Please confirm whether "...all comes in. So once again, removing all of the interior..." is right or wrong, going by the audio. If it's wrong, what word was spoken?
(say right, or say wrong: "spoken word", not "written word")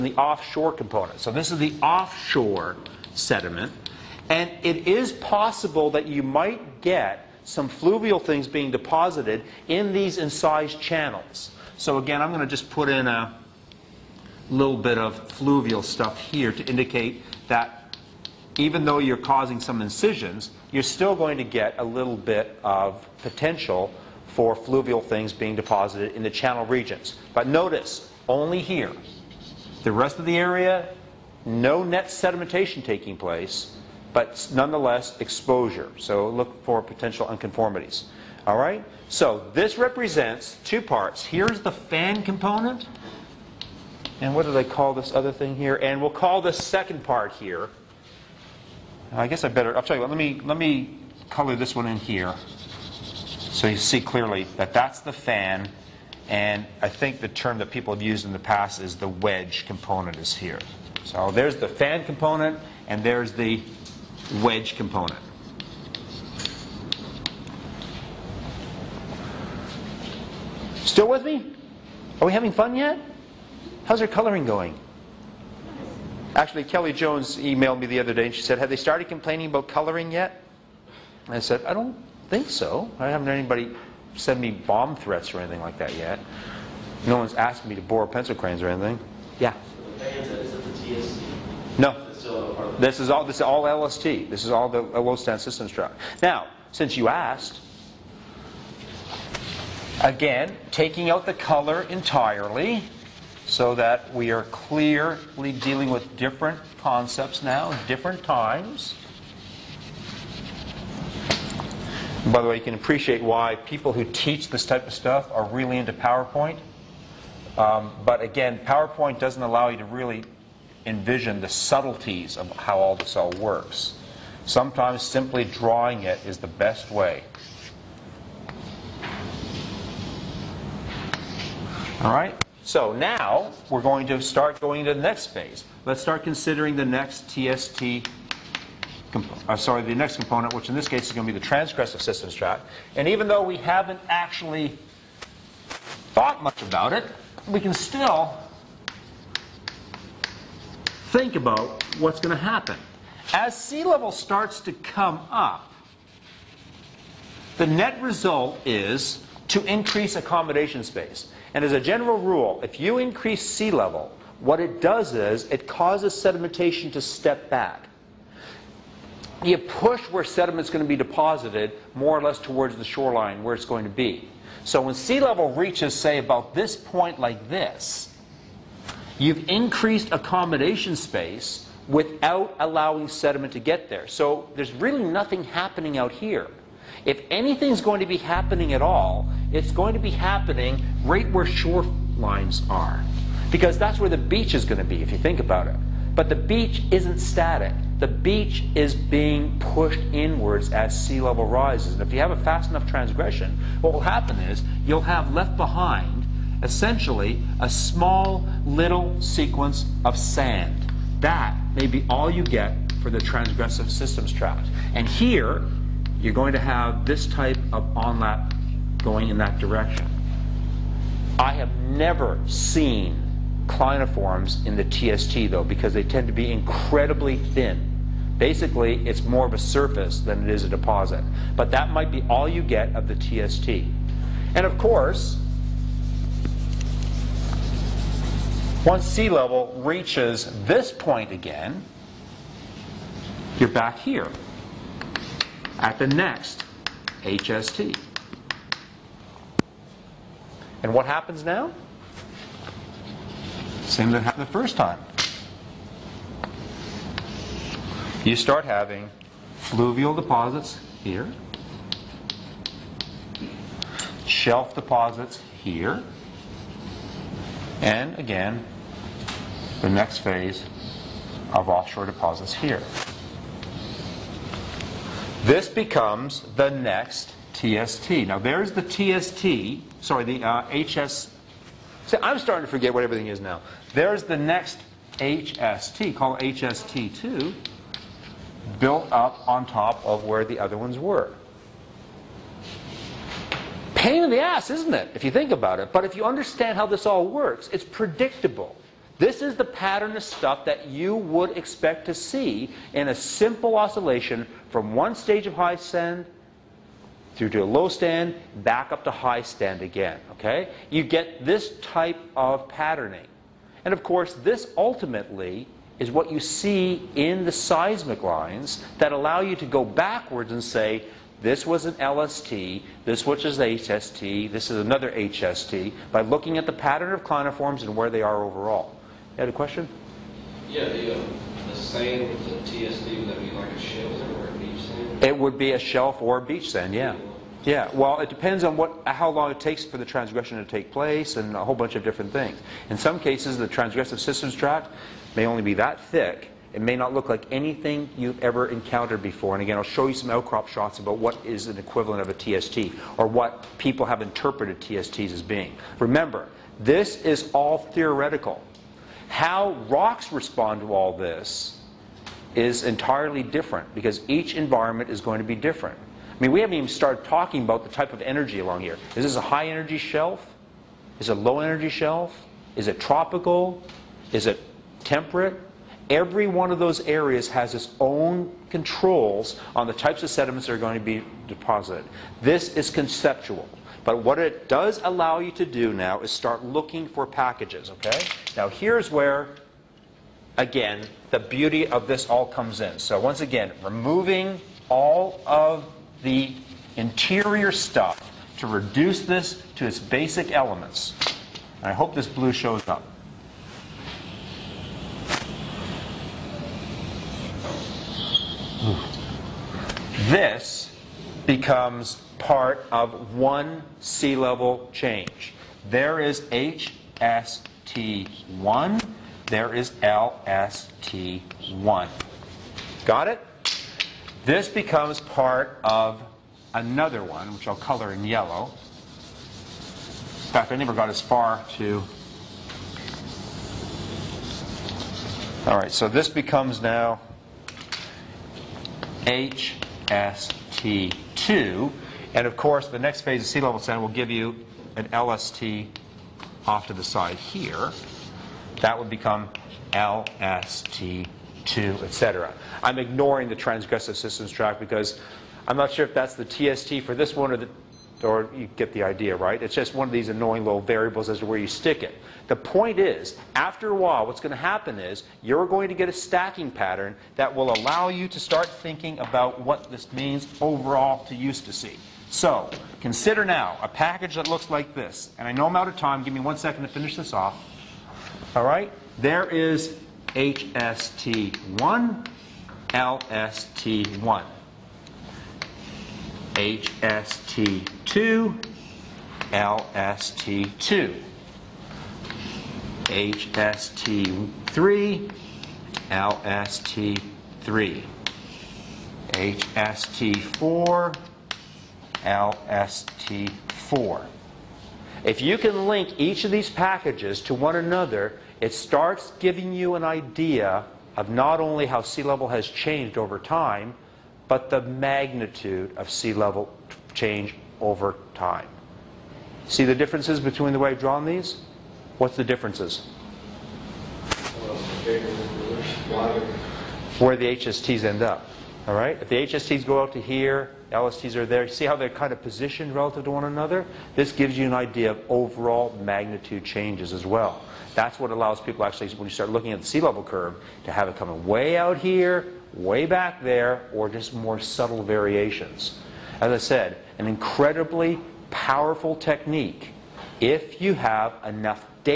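right.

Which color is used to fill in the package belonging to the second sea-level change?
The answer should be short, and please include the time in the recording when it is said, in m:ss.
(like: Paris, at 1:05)
yellow, at 7:08.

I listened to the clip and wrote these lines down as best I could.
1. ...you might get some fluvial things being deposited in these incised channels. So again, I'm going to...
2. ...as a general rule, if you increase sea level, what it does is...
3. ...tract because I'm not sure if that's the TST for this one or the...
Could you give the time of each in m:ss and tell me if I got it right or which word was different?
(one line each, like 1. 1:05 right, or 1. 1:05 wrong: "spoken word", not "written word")
1. 0:06 right
2. 2:41 right
3. 7:34 right.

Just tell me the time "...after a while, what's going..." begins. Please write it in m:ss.
7:43.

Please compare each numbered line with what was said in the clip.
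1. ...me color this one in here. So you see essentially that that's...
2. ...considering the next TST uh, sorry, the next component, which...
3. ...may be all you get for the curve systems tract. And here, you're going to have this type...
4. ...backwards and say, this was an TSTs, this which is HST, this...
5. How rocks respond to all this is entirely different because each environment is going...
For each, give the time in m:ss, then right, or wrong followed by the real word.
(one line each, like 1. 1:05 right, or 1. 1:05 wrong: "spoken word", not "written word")
1. 0:50 wrong: "clearly", not "essentially"
2. 2:16 right
3. 3:31 wrong: "transgressive", not "curve"
4. 5:19 wrong: "LST", not "TSTs"
5. 5:59 right.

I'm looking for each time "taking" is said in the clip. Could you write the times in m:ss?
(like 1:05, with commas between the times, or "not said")
0:32, 1:40.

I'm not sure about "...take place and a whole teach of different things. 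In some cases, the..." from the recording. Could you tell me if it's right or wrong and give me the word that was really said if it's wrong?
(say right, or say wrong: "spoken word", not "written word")
wrong: "bunch", not "teach".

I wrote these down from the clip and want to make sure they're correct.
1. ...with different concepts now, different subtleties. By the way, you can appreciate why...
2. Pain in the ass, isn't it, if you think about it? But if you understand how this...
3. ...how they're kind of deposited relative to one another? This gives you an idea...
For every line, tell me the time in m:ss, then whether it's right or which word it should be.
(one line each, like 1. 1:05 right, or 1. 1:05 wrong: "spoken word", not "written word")
1. 1:45 wrong: "times", not "subtleties"
2. 4:53 right
3. 8:51 wrong: "positioned", not "deposited".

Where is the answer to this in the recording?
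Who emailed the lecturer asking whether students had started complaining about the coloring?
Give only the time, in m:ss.
1:16.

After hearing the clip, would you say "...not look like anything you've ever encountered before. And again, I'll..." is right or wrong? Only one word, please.
right.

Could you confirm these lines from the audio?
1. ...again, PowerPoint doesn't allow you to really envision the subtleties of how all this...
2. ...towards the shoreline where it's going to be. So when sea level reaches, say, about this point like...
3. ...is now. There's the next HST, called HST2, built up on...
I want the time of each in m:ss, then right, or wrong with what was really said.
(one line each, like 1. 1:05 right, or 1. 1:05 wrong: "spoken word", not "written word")
1. 1:58 right
2. 2:52 right
3. 4:43 right.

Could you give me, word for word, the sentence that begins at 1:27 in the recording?
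No one's asked me to borrow pencil cranes or anything.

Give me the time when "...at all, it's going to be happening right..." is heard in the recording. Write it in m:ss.
3:08.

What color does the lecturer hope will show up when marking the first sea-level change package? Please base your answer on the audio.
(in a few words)
blue.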